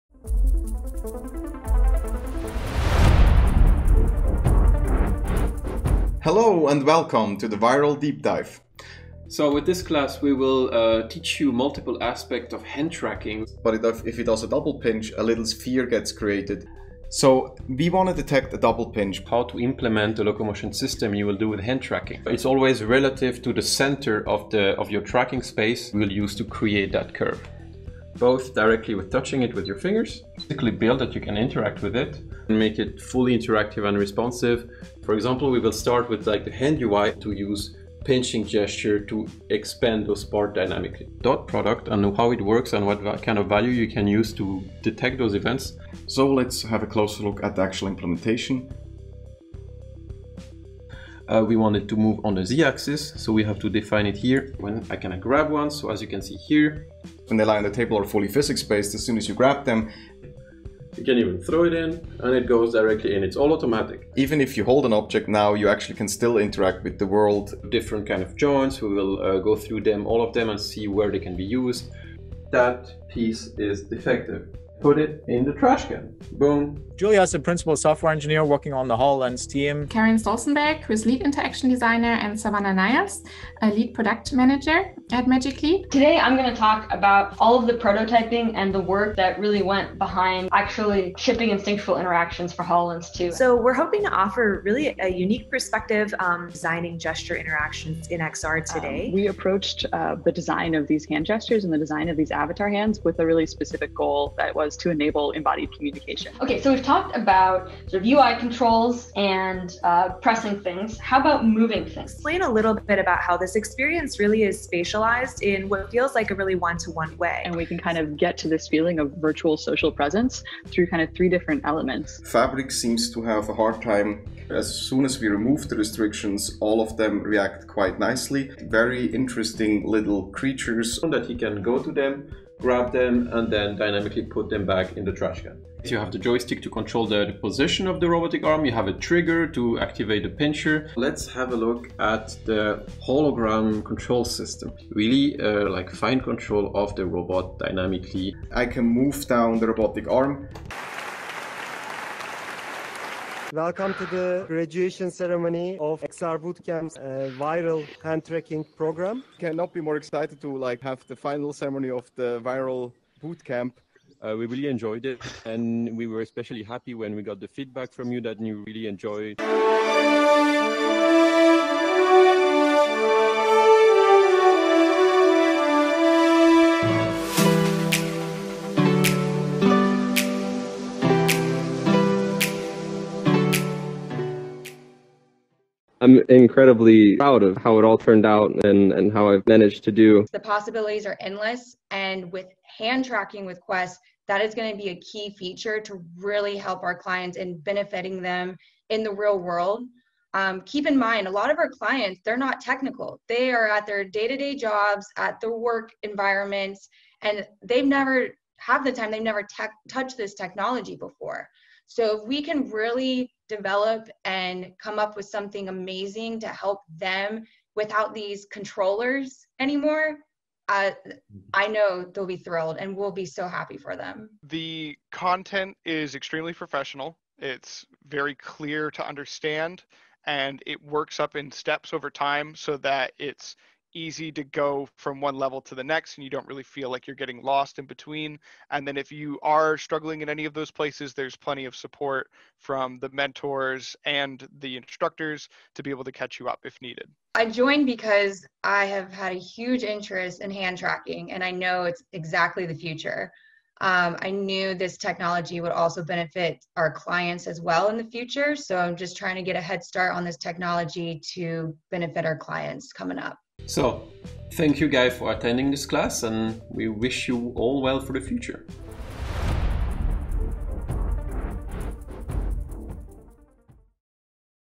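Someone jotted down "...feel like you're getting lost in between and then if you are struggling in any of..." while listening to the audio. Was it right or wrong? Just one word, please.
right.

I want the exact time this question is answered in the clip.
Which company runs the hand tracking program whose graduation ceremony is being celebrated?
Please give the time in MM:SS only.
02:35.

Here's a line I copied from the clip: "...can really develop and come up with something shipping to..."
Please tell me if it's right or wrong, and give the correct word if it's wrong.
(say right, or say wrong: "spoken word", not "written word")
wrong: "amazing", not "shipping".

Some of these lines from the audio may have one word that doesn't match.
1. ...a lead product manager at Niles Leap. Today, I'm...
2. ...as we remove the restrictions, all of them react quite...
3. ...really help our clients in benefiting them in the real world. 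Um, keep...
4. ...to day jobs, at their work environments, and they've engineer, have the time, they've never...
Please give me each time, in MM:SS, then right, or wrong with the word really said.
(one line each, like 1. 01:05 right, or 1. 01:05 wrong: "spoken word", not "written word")
1. 01:23 wrong: "Magic", not "Niles"
2. 02:05 right
3. 03:16 right
4. 03:24 wrong: "never", not "engineer".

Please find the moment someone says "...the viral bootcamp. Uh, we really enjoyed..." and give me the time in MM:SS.
02:42.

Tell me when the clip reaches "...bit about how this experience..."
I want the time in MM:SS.
01:52.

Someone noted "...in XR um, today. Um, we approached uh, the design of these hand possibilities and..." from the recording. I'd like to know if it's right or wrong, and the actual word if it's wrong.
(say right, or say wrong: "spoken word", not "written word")
wrong: "gestures", not "possibilities".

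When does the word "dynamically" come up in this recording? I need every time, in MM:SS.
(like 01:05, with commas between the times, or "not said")
00:40, 02:13, 02:27.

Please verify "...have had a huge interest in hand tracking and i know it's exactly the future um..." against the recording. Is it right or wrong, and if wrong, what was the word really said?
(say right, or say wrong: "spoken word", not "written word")
right.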